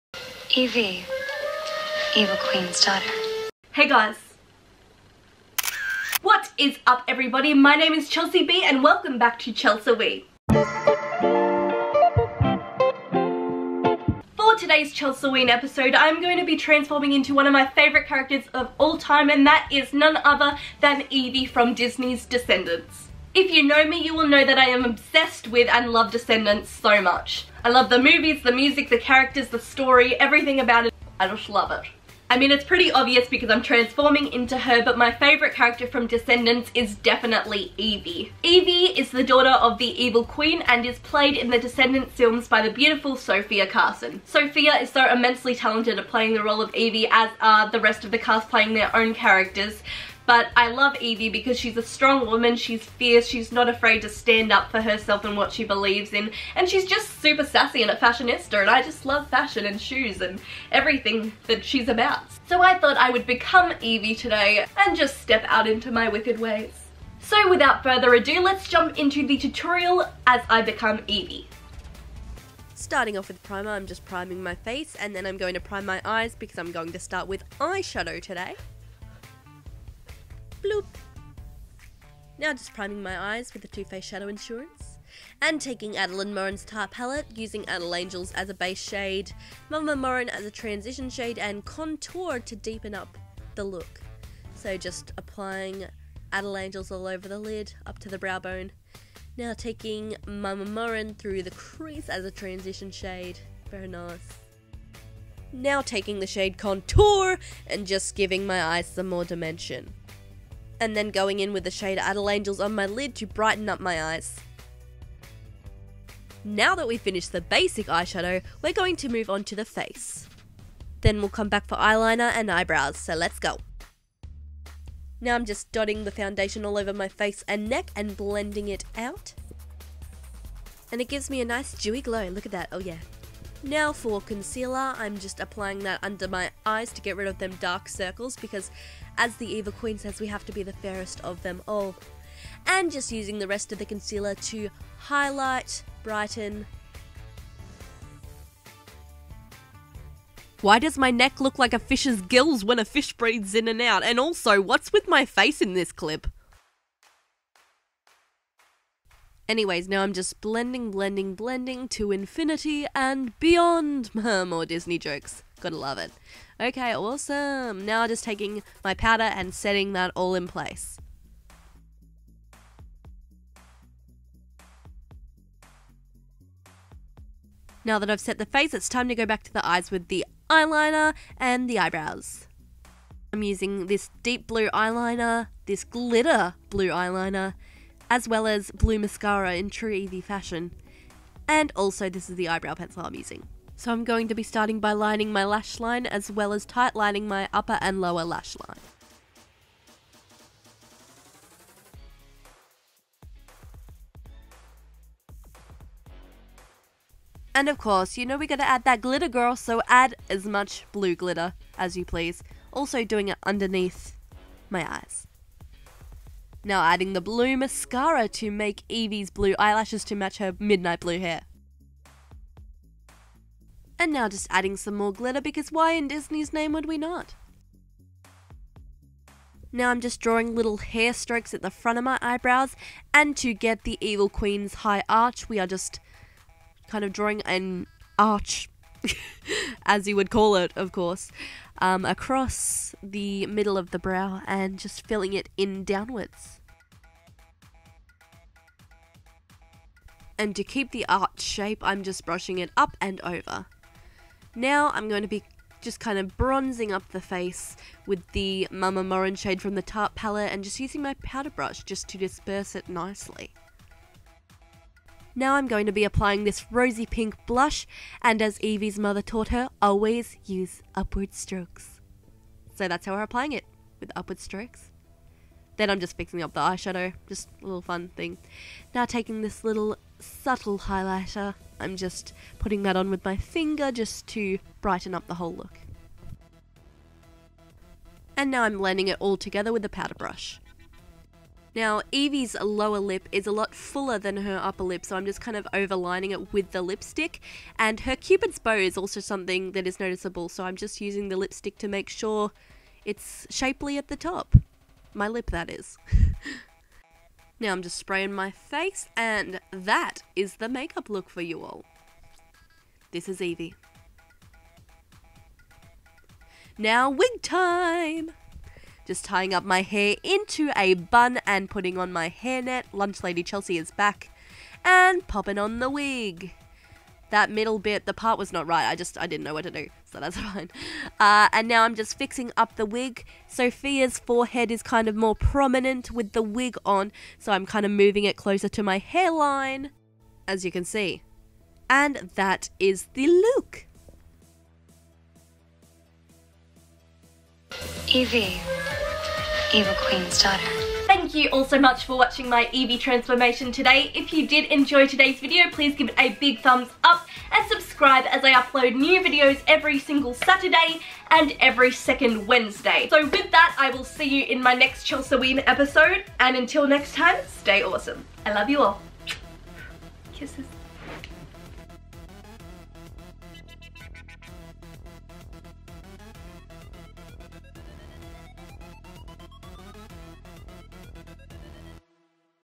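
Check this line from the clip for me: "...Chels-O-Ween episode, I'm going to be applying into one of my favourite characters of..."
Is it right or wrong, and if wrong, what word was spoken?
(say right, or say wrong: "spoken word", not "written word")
wrong: "transforming", not "applying".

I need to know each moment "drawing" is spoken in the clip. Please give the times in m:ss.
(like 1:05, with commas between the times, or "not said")
3:50, 3:57.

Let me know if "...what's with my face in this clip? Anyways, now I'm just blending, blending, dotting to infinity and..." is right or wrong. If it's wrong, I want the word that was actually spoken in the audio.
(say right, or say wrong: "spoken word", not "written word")
wrong: "blending", not "dotting".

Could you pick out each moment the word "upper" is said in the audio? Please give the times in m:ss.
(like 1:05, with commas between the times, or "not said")
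3:17, 4:54.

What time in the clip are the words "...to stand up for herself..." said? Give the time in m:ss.
0:54.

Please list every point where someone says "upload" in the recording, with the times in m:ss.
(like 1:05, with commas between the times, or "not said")
5:58.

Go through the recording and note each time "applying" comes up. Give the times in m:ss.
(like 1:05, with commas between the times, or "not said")
1:35, 2:15, 4:26, 4:33.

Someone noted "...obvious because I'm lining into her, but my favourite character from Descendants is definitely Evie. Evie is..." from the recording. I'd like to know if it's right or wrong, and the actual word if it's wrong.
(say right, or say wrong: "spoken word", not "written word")
wrong: "transforming", not "lining".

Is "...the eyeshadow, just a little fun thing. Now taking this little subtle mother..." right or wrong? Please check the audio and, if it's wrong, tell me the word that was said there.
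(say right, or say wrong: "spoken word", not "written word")
wrong: "highlighter", not "mother".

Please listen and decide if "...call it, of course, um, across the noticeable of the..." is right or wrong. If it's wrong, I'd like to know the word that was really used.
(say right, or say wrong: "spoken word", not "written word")
wrong: "middle", not "noticeable".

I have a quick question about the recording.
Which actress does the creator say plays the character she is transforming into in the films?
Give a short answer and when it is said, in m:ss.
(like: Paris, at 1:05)
Sofia Carson, at 0:43.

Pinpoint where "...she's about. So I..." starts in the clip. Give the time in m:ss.
1:01.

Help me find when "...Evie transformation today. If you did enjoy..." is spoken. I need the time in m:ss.
5:52.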